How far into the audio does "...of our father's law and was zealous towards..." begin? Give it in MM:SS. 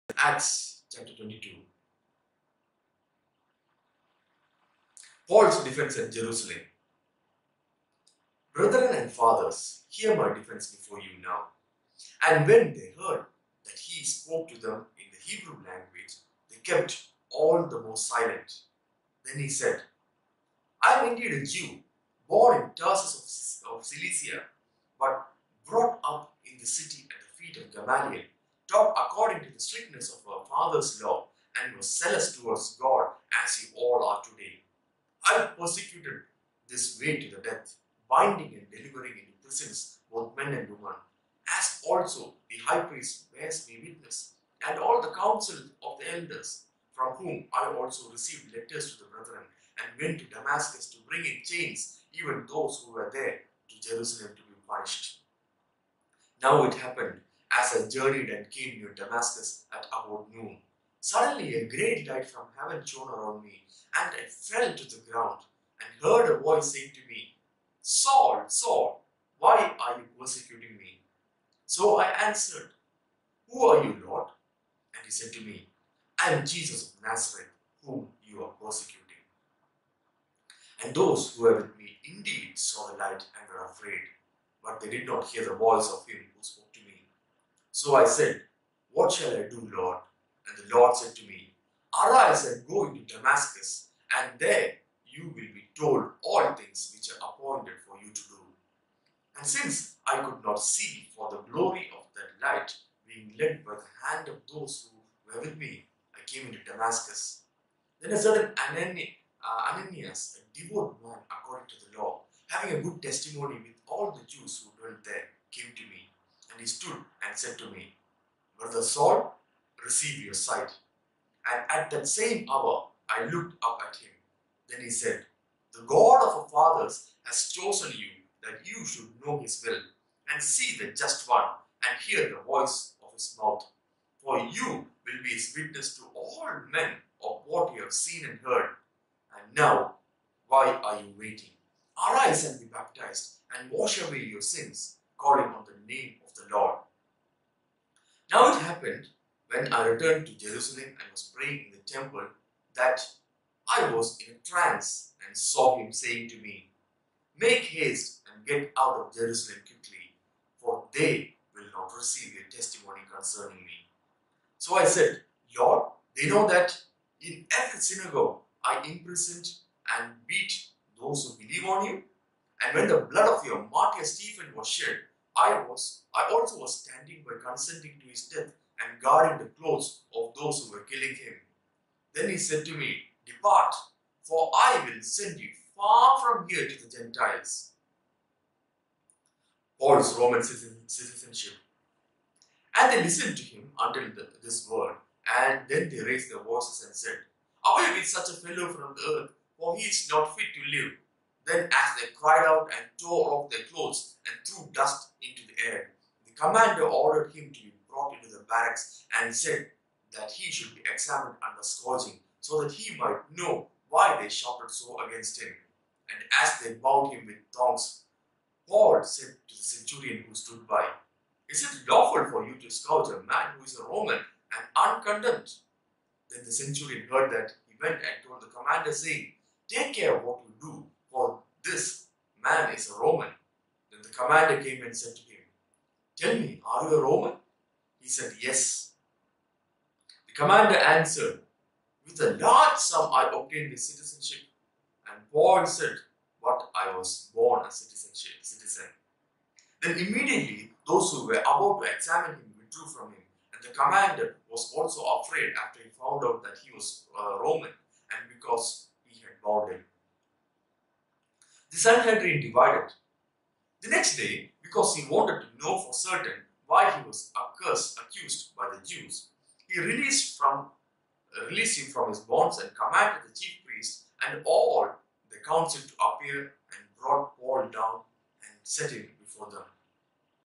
00:30.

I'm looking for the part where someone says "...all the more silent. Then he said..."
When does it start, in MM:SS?
00:17.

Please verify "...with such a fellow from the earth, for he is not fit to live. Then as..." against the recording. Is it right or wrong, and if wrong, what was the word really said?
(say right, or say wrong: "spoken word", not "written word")
right.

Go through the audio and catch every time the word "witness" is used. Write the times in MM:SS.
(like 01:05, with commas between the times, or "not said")
00:43, 02:15.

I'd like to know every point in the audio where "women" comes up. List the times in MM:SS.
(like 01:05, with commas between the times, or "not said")
00:40.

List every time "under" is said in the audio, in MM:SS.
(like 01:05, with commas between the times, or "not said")
03:31.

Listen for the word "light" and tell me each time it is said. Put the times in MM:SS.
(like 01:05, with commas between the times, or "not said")
01:02, 01:22, 01:42.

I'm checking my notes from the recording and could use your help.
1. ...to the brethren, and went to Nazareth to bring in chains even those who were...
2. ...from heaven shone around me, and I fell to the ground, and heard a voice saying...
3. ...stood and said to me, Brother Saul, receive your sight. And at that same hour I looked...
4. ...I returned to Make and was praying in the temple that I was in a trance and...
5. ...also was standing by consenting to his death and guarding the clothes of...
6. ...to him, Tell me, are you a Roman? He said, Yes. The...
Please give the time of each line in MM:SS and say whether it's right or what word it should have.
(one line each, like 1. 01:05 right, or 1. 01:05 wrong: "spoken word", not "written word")
1. 00:48 wrong: "Damascus", not "Nazareth"
2. 01:02 right
3. 01:56 right
4. 02:29 wrong: "Jerusalem", not "Make"
5. 02:56 right
6. 03:55 right.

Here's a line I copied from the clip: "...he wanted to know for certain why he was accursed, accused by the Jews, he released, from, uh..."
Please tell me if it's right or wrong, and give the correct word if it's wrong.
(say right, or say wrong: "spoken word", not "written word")
right.